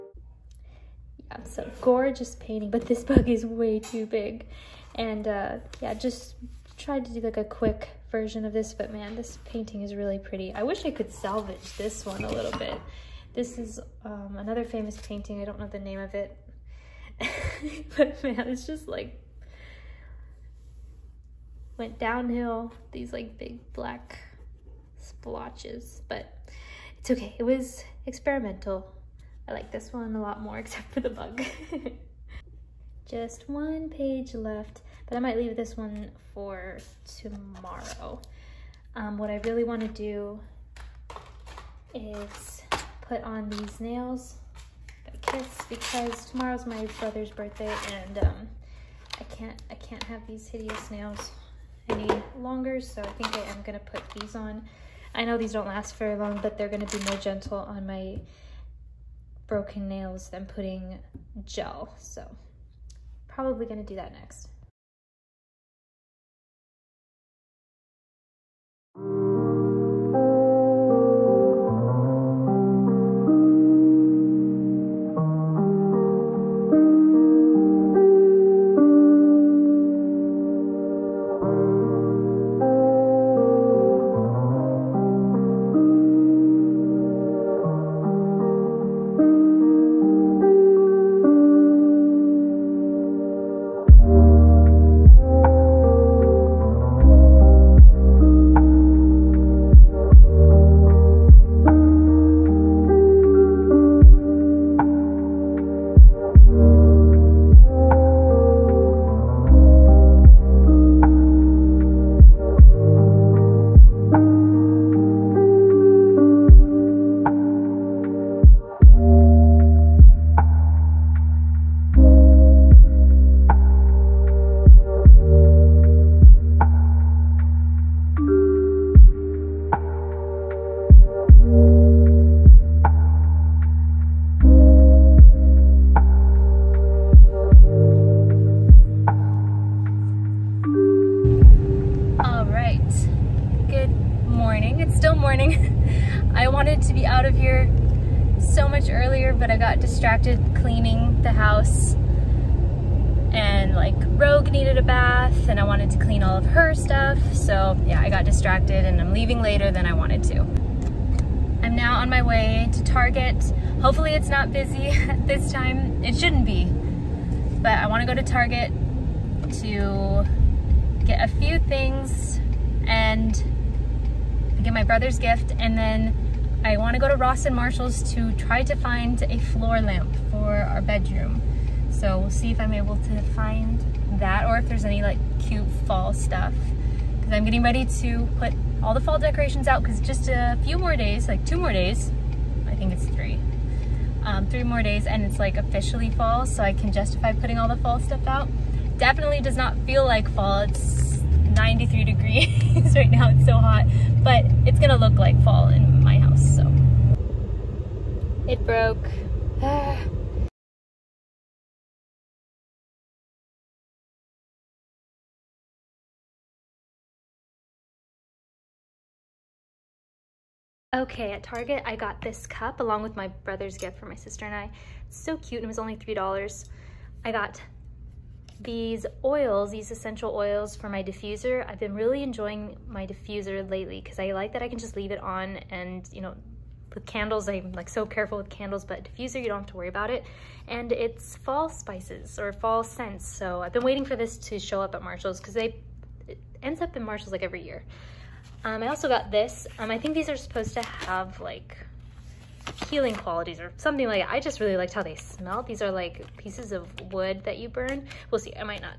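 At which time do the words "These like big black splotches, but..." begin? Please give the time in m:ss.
0:22.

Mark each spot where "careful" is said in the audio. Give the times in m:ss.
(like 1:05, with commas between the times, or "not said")
3:58.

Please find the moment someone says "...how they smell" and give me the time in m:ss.
4:14.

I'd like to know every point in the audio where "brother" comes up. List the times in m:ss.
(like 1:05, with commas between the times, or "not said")
0:46, 2:54, 3:43.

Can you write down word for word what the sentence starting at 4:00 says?
And it's fall spices or fall scents.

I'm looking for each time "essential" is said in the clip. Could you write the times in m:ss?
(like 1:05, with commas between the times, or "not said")
3:49.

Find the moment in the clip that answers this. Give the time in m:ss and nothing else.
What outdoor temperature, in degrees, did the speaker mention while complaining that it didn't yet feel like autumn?
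3:21.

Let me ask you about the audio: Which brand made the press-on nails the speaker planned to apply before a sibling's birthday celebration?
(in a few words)
Kiss.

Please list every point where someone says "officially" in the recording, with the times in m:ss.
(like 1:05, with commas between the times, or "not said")
3:15.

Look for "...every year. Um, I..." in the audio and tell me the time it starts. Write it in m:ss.
4:07.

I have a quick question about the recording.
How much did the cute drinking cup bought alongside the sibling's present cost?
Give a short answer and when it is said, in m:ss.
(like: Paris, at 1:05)
$3, at 3:45.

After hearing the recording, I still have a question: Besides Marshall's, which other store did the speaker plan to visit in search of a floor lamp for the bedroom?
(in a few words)
Ross.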